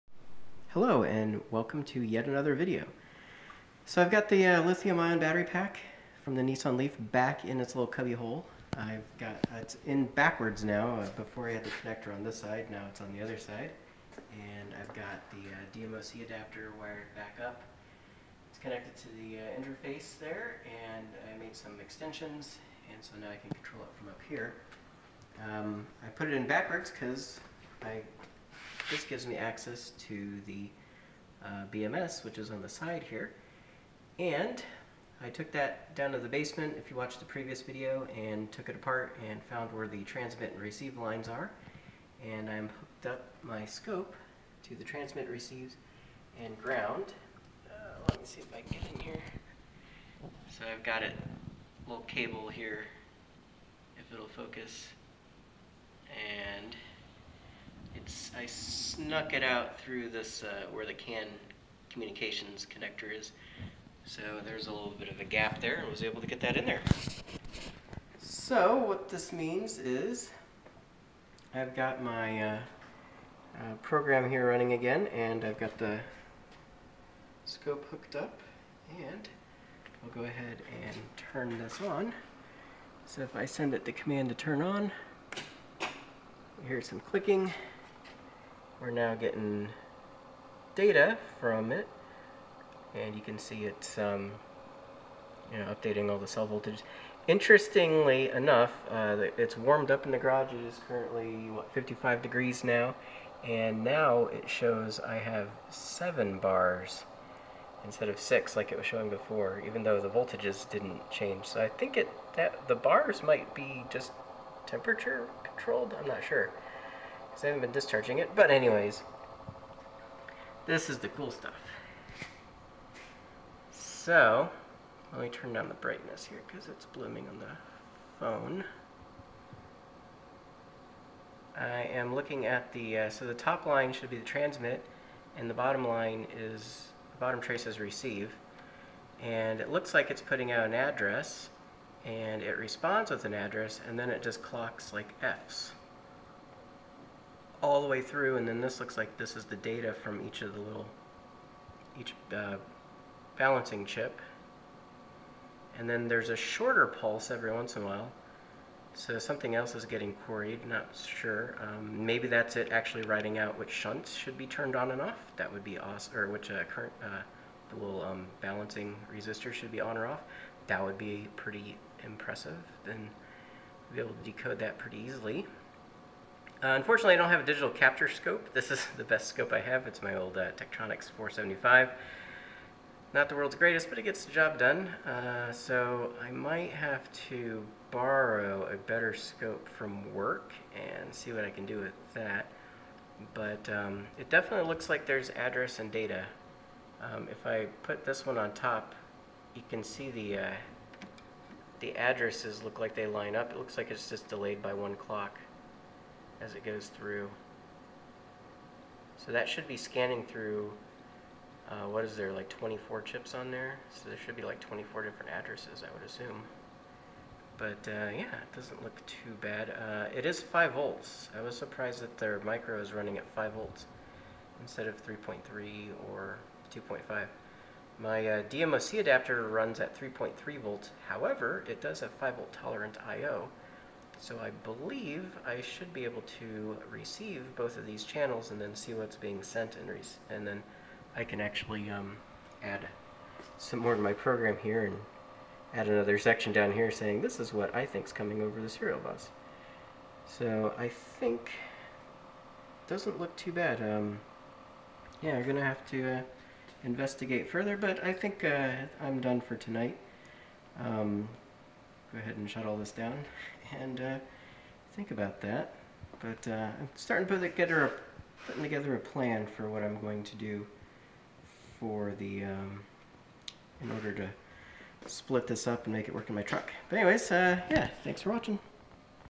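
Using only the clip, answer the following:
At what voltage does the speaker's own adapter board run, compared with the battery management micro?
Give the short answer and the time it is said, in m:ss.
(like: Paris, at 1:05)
3.3 volts, at 3:49.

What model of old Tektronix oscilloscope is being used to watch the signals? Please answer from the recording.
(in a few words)
475.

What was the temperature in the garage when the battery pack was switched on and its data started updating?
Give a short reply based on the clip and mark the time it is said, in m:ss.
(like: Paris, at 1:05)
55 degrees, at 1:41.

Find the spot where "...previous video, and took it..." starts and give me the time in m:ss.
0:37.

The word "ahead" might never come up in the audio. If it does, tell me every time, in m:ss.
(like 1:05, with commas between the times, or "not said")
1:20, 4:22.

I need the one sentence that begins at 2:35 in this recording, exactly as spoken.
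And then there's a shorter pulse every once in a while.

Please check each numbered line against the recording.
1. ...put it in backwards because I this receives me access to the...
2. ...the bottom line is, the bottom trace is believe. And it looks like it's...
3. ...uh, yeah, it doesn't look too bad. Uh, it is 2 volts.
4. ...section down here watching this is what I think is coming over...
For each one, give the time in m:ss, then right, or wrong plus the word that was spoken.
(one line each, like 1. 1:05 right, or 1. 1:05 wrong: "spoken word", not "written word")
1. 0:26 wrong: "gives", not "receives"
2. 2:15 wrong: "receive", not "believe"
3. 3:37 wrong: "5", not "2"
4. 4:06 wrong: "saying", not "watching".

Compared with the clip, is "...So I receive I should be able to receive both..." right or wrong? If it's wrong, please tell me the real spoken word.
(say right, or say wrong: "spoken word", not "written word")
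wrong: "believe", not "receive".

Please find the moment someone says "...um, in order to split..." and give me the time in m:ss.
4:32.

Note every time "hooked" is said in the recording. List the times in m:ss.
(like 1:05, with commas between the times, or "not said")
0:42, 1:17.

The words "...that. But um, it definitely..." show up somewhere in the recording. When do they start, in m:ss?
3:12.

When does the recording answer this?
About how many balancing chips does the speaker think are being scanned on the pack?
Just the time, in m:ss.
3:32.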